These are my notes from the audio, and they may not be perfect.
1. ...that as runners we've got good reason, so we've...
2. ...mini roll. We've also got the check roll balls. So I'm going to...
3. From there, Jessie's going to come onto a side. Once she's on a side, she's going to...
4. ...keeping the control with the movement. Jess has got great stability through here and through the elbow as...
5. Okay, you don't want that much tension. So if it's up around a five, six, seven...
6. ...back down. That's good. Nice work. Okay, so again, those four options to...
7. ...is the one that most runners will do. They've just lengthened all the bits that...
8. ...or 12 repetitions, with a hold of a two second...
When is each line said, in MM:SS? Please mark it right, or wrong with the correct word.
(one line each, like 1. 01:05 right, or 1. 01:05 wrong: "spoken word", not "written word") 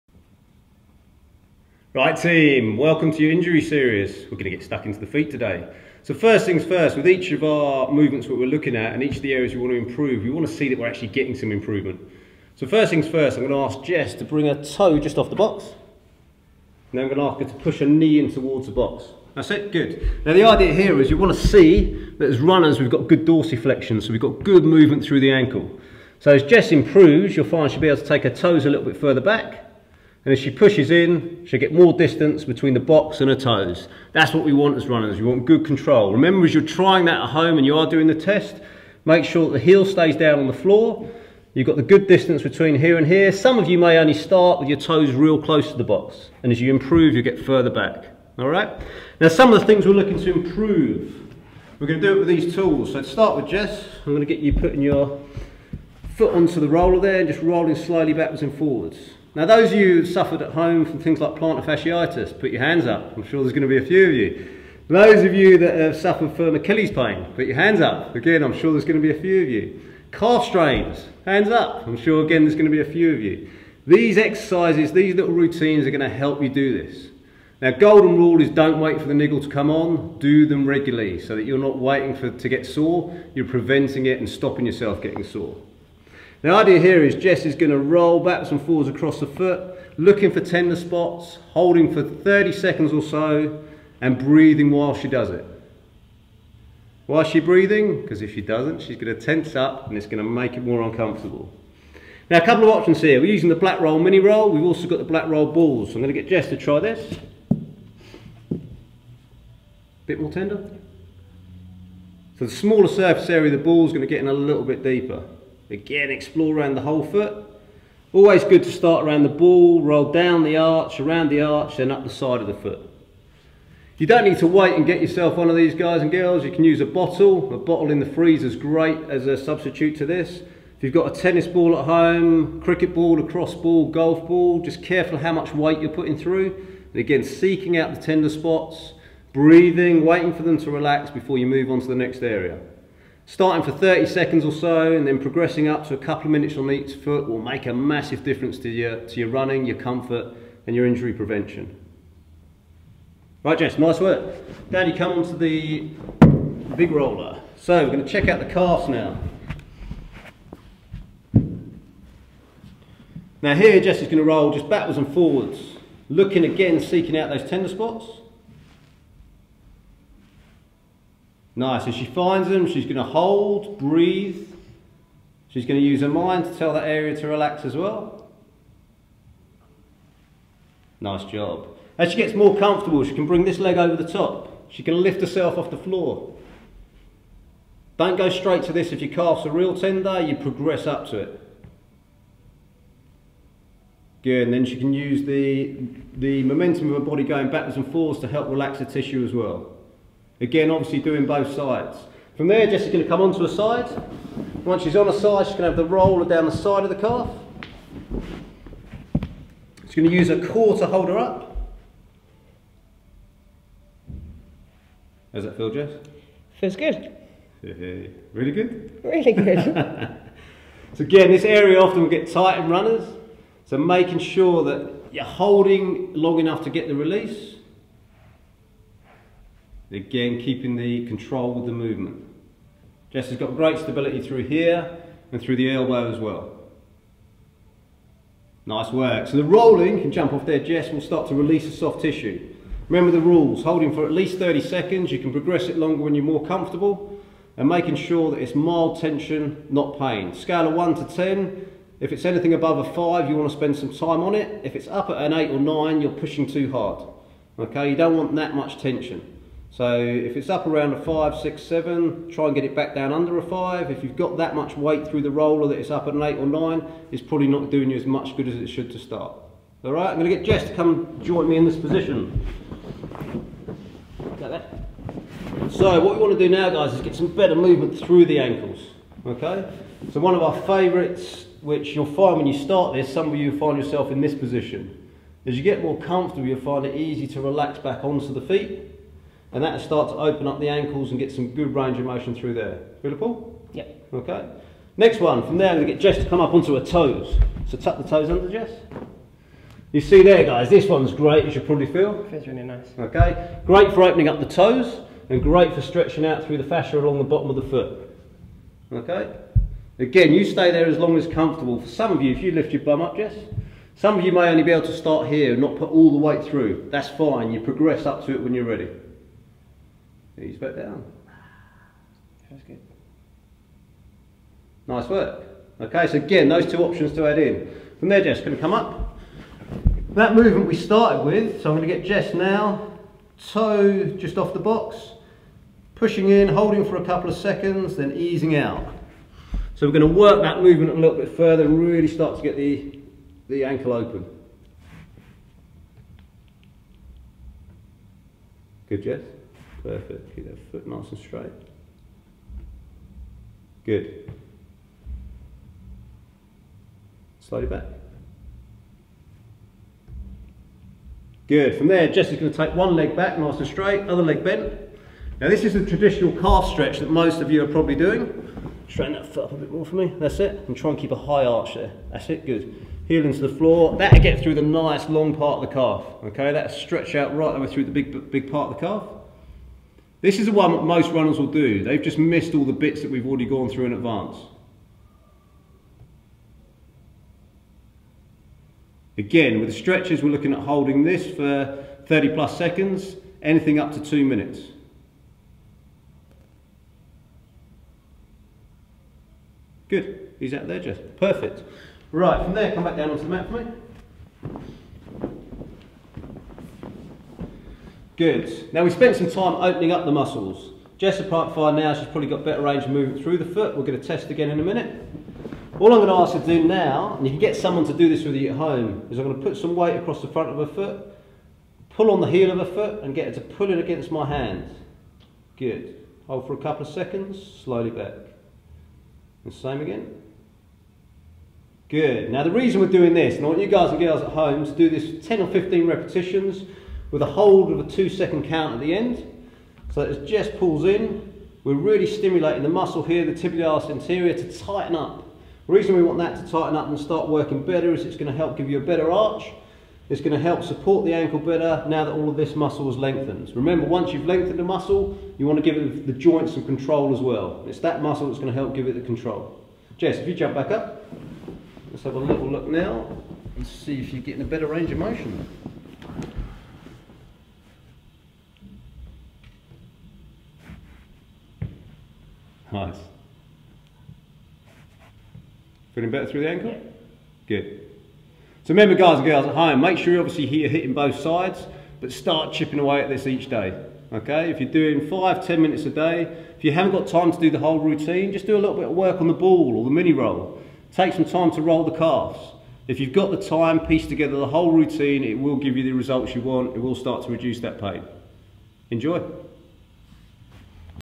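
1. 00:22 wrong: "dorsiflexion", not "reason"
2. 01:43 wrong: "black", not "check"
3. 03:22 right
4. 03:50 right
5. 04:17 right
6. 05:20 wrong: "two", not "four"
7. 06:20 wrong: "missed", not "lengthened"
8. 07:15 wrong: "15", not "12".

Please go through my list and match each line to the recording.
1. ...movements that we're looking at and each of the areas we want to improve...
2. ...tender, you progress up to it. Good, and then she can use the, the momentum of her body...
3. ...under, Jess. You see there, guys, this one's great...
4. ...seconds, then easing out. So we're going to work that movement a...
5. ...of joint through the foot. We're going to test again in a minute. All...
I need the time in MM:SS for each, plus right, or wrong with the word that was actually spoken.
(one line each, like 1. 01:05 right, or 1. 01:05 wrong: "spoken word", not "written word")
1. 00:07 right
2. 03:09 right
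3. 04:58 right
4. 05:37 right
5. 06:52 wrong: "movement", not "joint".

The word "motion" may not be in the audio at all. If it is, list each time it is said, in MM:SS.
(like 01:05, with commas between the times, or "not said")
04:52, 07:44.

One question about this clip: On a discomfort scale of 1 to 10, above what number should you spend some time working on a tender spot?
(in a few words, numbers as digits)
5.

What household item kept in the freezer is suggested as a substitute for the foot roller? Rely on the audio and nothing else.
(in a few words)
A bottle.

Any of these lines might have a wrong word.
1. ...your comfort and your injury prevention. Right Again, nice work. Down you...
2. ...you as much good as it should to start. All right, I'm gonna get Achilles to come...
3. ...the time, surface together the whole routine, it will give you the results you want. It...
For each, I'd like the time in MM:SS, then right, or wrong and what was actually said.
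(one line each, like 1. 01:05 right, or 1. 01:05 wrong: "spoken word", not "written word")
1. 02:29 wrong: "Jess", not "Again"
2. 04:27 wrong: "Jess", not "Achilles"
3. 08:13 wrong: "piece", not "surface".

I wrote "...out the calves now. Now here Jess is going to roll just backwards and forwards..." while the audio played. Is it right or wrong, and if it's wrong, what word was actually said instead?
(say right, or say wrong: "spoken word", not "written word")
right.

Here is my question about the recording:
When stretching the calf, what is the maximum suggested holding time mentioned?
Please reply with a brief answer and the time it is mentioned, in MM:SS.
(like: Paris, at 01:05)
2 minutes, at 06:33.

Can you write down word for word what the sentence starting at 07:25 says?
The reason we want that to tighten up and start working better is it's going to help give you a better arch.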